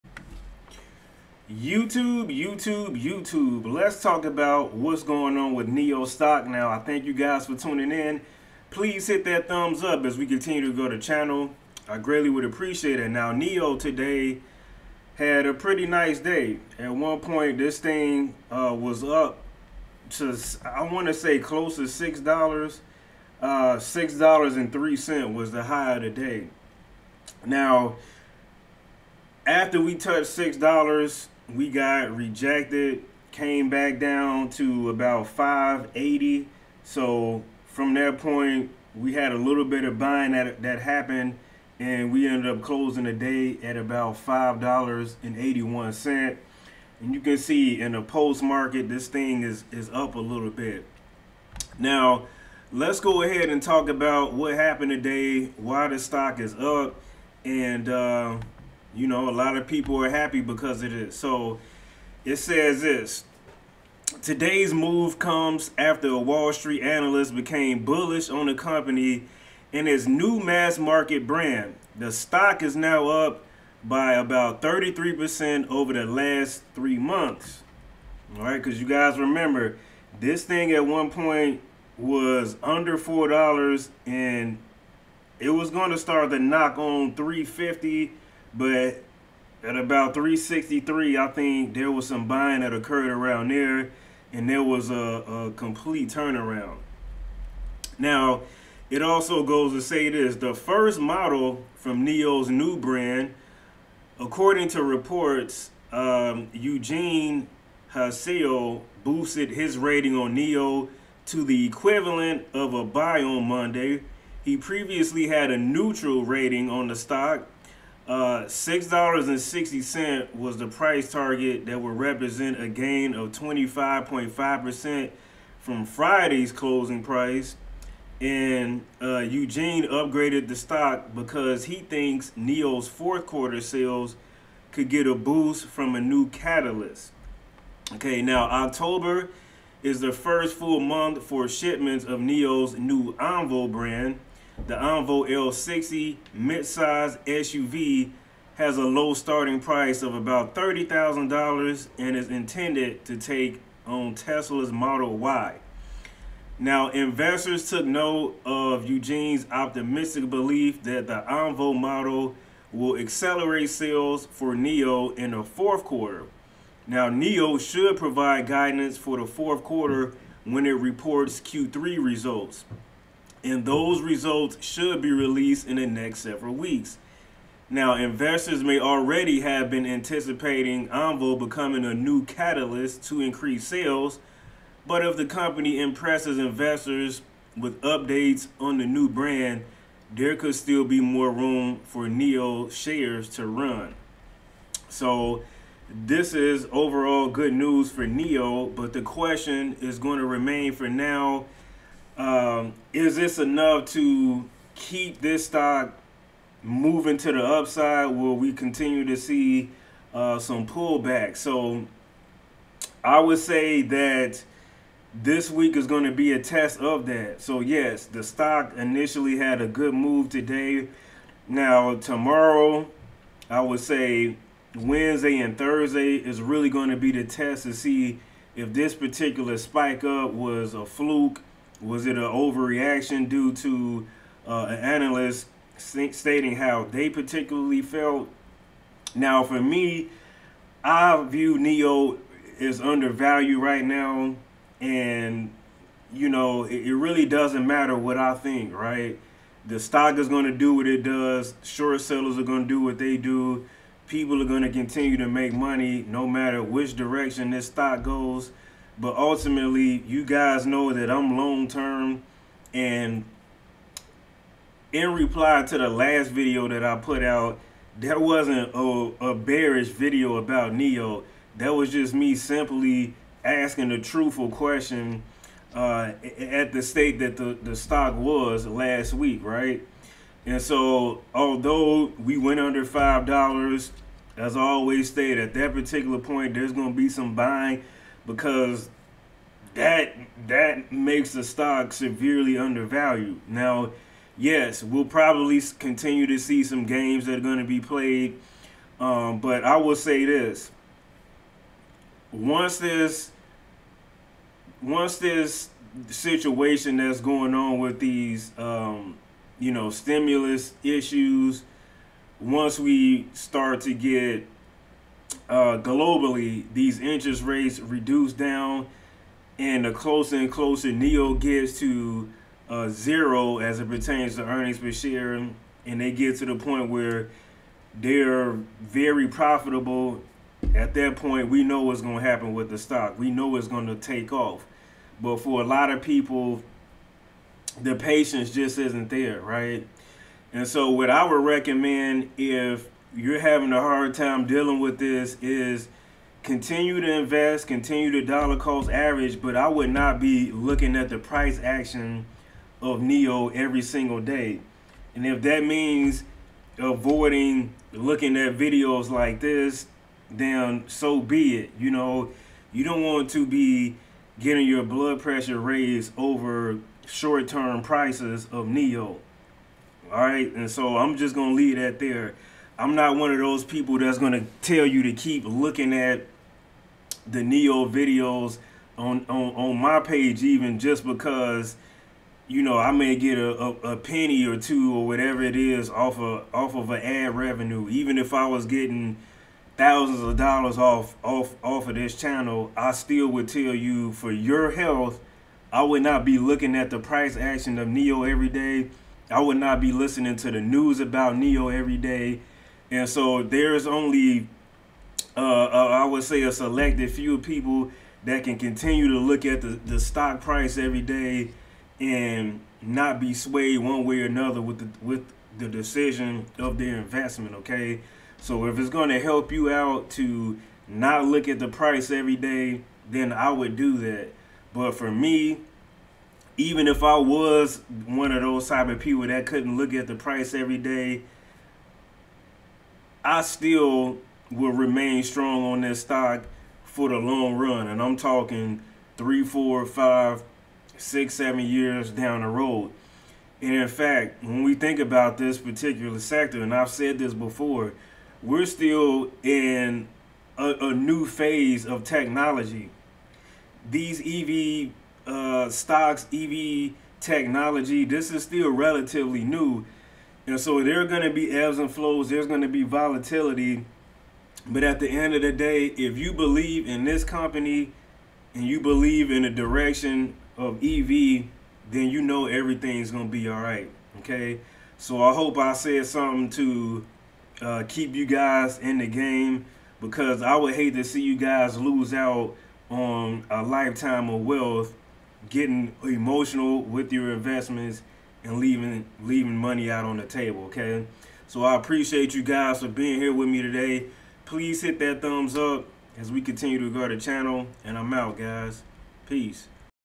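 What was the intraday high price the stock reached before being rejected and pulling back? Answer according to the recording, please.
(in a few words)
$6.03.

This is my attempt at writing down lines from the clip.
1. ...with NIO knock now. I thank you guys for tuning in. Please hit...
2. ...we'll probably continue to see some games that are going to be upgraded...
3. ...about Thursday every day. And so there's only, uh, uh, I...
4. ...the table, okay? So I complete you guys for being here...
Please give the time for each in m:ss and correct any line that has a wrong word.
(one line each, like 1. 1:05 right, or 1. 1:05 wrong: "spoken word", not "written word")
1. 0:05 wrong: "stock", not "knock"
2. 4:54 wrong: "played", not "upgraded"
3. 6:40 wrong: "NIO", not "Thursday"
4. 8:10 wrong: "appreciate", not "complete".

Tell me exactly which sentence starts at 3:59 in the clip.
Now, for me, I view NIO is undervalued right now, and you know it, it really doesn't matter what I think, right?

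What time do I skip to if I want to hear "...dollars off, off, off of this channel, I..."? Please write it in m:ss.
6:30.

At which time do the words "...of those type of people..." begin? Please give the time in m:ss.
7:08.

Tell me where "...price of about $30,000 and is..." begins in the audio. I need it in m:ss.
2:29.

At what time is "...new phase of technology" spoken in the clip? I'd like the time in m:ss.
7:30.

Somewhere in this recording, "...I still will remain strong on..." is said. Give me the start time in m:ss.
7:13.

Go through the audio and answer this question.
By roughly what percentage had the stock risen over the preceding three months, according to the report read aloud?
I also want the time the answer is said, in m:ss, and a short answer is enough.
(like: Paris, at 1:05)
33%, at 1:14.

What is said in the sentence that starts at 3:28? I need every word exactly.
Will we continue to see uh, some pullback?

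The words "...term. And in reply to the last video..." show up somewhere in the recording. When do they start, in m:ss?
4:21.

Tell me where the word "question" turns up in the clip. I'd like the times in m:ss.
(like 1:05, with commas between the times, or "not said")
3:19, 4:34.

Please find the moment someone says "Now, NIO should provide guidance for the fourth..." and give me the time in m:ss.
2:46.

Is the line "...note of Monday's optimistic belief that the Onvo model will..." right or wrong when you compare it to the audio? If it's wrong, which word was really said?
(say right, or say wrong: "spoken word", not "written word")
wrong: "Eugene", not "Monday".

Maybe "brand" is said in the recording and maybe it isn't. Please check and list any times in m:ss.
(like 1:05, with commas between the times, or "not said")
1:11, 1:42, 2:23, 3:09.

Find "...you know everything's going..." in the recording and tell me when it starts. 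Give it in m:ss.
7:52.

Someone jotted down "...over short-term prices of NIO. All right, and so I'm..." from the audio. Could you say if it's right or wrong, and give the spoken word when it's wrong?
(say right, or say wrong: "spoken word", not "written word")
right.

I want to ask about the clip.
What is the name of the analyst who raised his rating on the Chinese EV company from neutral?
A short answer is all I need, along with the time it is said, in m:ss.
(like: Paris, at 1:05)
Eugene Hsiao, at 1:46.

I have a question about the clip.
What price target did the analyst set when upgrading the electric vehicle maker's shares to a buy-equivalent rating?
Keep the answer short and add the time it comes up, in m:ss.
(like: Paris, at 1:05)
$6.60, at 1:58.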